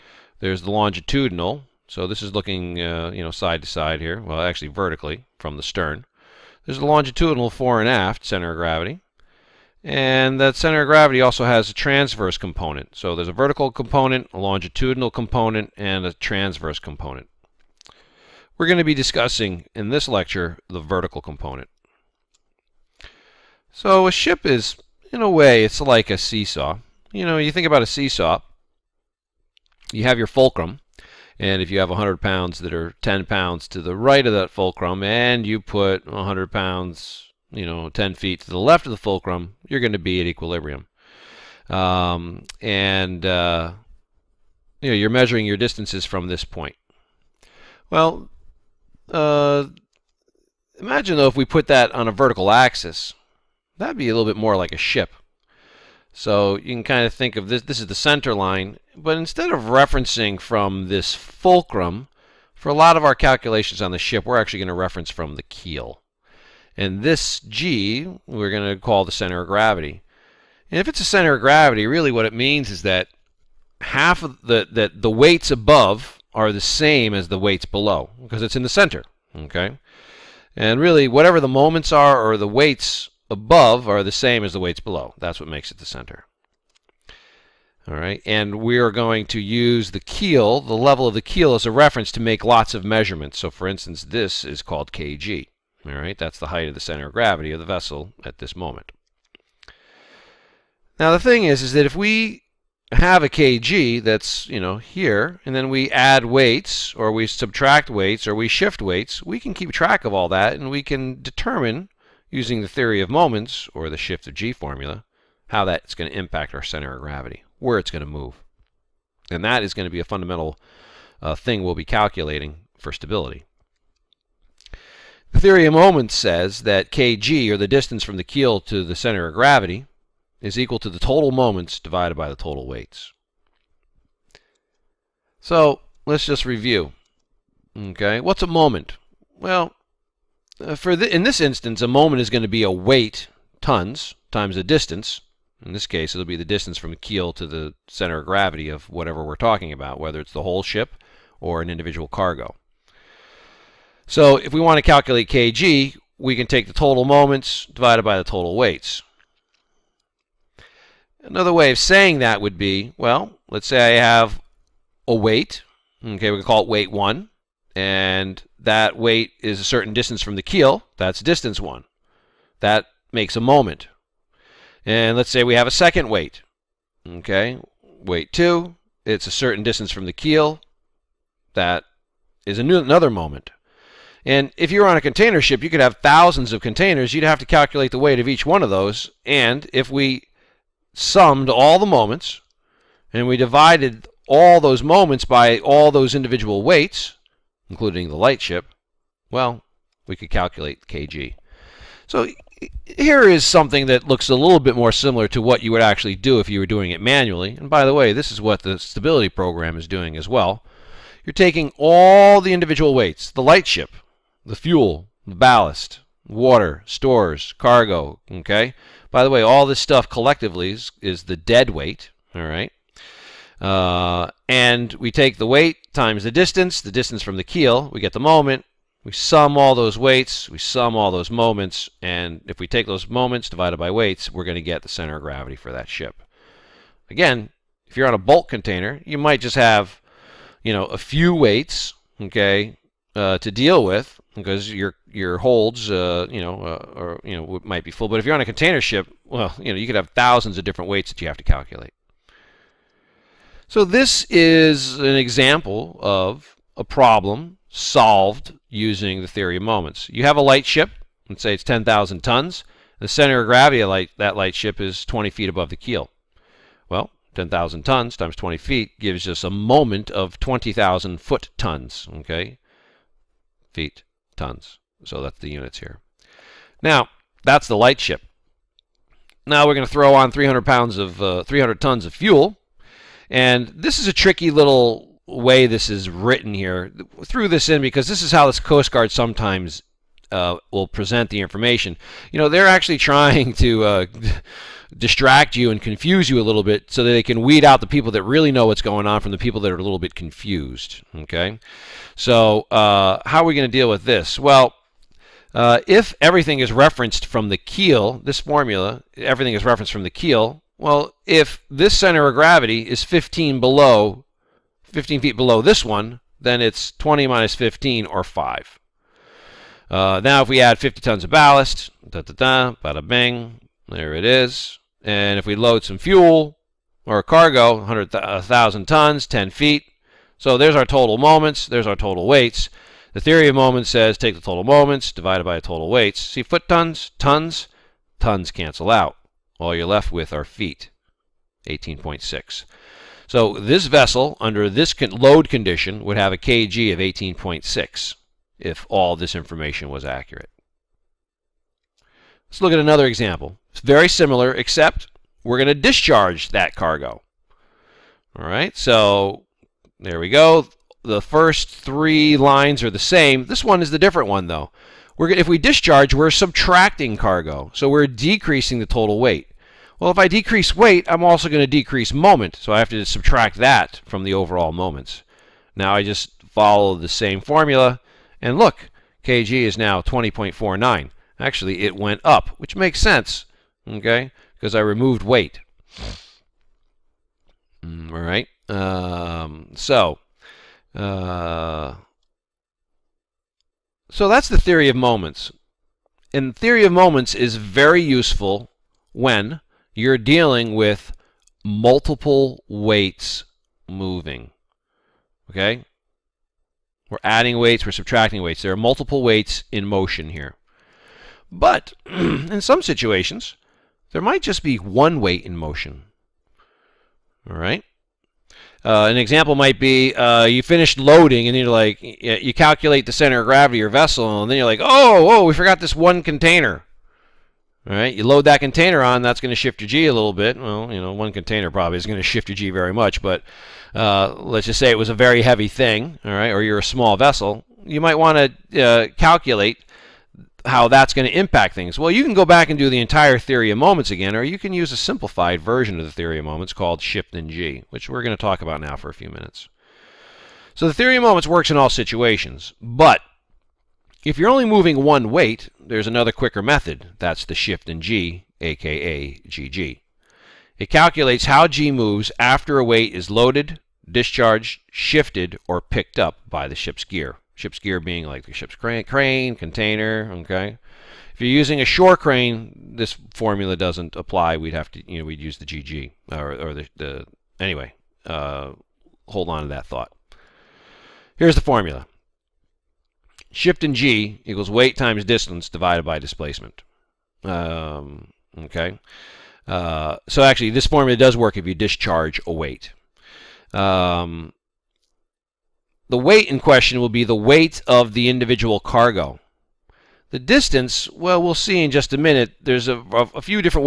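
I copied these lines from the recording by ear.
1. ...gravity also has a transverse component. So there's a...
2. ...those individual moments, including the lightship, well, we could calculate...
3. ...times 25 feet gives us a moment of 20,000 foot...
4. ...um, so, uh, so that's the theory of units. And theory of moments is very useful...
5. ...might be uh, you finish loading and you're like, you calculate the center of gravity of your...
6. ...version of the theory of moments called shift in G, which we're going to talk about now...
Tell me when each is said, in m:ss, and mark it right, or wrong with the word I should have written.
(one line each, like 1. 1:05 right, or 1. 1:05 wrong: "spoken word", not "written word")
1. 0:10 right
2. 3:15 wrong: "weights", not "moments"
3. 4:28 wrong: "20", not "25"
4. 6:28 wrong: "moments", not "units"
5. 6:59 right
6. 7:25 right.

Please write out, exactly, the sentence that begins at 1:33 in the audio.
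So, for instance, this is called kg.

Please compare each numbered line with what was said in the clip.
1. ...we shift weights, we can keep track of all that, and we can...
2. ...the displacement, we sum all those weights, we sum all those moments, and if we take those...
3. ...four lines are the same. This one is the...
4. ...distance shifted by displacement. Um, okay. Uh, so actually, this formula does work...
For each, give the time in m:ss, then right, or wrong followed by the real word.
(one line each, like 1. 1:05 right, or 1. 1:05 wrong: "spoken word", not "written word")
1. 1:48 right
2. 3:48 wrong: "moment", not "displacement"
3. 6:01 wrong: "three", not "four"
4. 8:05 wrong: "divided", not "shifted".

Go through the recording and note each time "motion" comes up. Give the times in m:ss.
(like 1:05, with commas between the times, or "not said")
6:49, 6:55.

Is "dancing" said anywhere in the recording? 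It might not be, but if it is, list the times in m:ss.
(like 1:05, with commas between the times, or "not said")
not said.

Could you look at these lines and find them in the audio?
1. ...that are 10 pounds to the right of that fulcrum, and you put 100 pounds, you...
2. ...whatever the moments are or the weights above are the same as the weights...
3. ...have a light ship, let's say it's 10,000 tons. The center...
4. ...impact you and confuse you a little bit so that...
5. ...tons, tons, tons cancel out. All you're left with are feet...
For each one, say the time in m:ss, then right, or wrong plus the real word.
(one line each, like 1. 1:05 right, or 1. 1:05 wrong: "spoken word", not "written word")
1. 0:32 right
2. 1:21 right
3. 4:20 right
4. 4:54 wrong: "distract", not "impact"
5. 5:36 right.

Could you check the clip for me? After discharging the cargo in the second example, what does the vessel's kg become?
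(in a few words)
20.49.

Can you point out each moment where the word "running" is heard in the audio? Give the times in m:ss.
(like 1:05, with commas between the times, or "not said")
not said.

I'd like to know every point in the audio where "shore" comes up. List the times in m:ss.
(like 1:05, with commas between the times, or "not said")
7:51.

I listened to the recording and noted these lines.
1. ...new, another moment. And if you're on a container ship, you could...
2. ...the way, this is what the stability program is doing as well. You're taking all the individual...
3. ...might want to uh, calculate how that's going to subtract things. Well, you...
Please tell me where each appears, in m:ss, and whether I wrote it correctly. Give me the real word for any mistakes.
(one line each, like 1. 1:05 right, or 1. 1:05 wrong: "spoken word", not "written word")
1. 3:02 right
2. 3:27 right
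3. 7:18 wrong: "impact", not "subtract".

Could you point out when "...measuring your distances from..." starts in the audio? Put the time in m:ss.
0:45.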